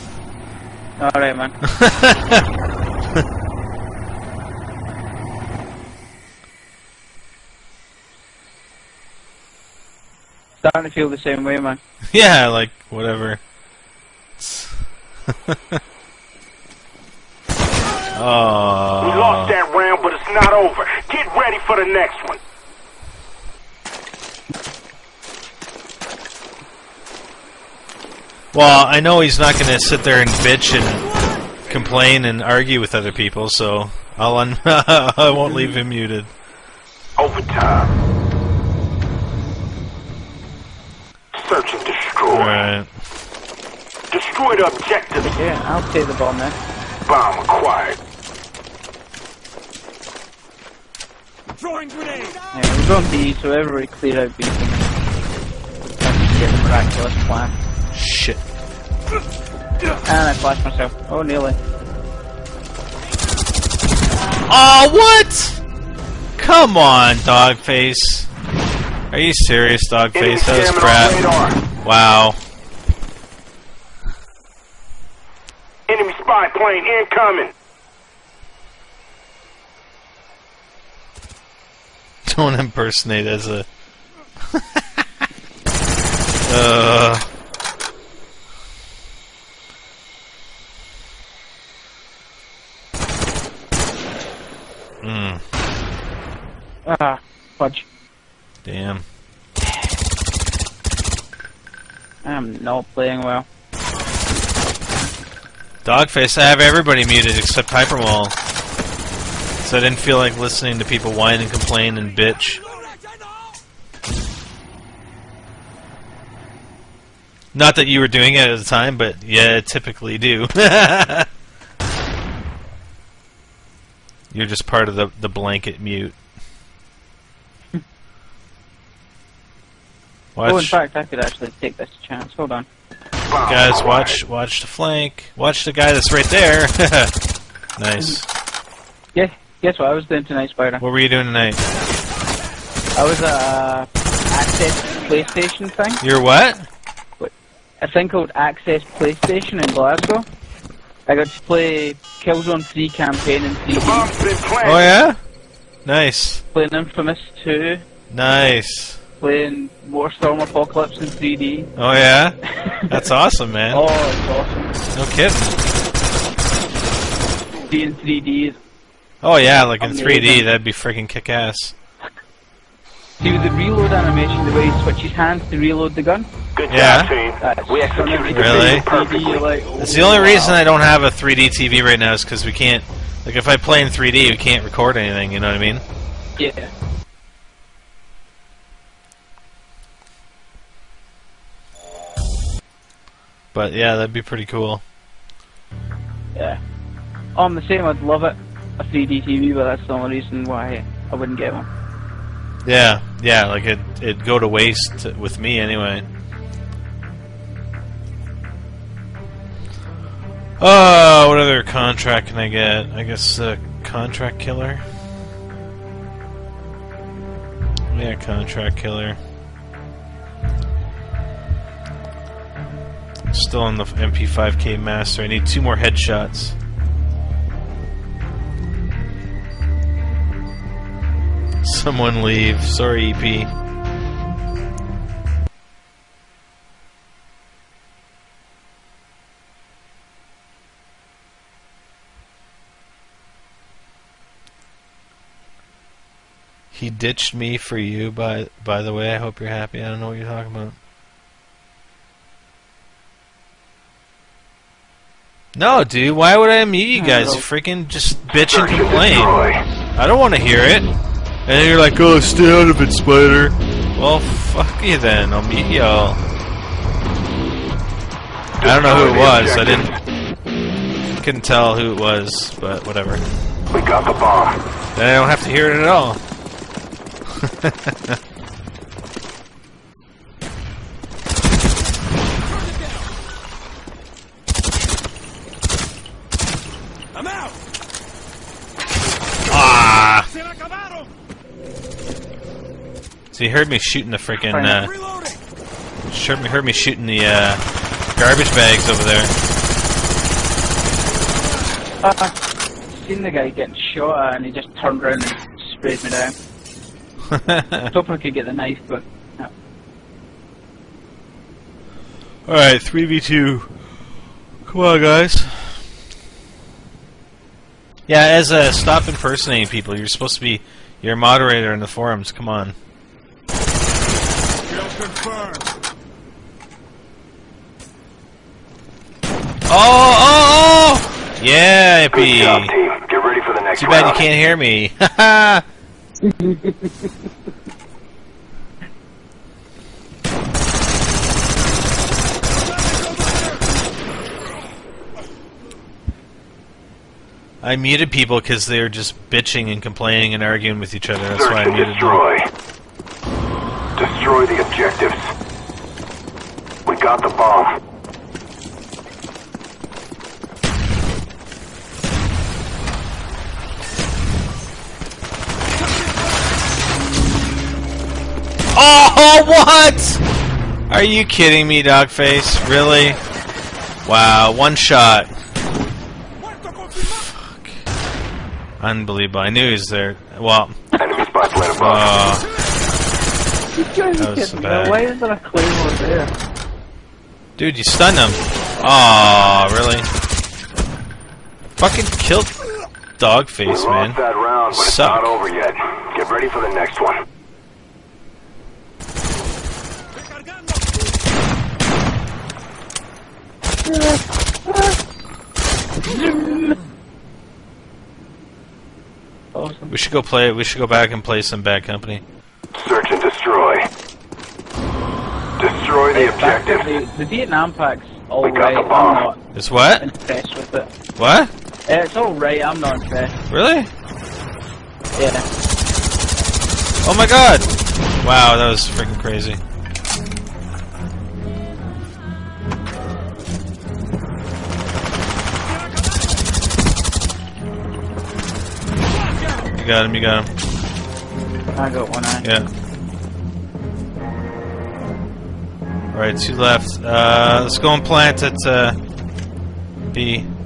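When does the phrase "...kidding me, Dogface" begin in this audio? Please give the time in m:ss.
6:11.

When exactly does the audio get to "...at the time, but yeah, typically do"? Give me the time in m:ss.
1:58.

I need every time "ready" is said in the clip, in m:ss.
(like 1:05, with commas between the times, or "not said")
0:21, 5:33, 6:36.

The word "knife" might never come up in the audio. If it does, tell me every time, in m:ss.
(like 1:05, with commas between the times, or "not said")
5:08.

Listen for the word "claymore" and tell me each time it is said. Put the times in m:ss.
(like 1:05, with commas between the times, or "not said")
6:25.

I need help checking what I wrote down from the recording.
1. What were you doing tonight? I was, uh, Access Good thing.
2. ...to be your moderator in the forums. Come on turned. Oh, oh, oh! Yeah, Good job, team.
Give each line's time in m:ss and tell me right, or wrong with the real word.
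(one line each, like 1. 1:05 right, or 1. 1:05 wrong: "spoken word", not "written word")
1. 2:20 wrong: "PlayStation", not "Good"
2. 5:20 wrong: "confirmed", not "turned".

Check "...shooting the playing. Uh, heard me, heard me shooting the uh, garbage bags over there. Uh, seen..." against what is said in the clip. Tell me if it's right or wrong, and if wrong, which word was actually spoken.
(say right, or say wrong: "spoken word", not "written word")
wrong: "freaking", not "playing".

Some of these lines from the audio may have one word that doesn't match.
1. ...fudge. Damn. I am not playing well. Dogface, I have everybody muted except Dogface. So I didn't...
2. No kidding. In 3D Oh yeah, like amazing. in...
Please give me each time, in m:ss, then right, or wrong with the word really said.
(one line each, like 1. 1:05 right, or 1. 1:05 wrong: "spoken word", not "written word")
1. 1:37 wrong: "Hyperwall", not "Dogface"
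2. 2:44 right.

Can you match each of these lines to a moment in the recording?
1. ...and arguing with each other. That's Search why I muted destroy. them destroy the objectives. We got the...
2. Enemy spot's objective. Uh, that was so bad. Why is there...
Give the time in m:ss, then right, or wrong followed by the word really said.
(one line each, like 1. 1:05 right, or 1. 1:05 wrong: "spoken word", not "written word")
1. 5:50 right
2. 6:20 wrong: "above", not "objective".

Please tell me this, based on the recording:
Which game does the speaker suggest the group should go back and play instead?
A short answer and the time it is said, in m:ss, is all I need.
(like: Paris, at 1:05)
Bad Company, at 6:51.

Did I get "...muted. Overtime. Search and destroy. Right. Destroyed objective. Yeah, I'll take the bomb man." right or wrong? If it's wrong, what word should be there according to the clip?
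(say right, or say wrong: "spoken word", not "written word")
right.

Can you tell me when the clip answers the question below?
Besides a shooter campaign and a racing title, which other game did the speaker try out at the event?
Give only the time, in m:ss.
2:36.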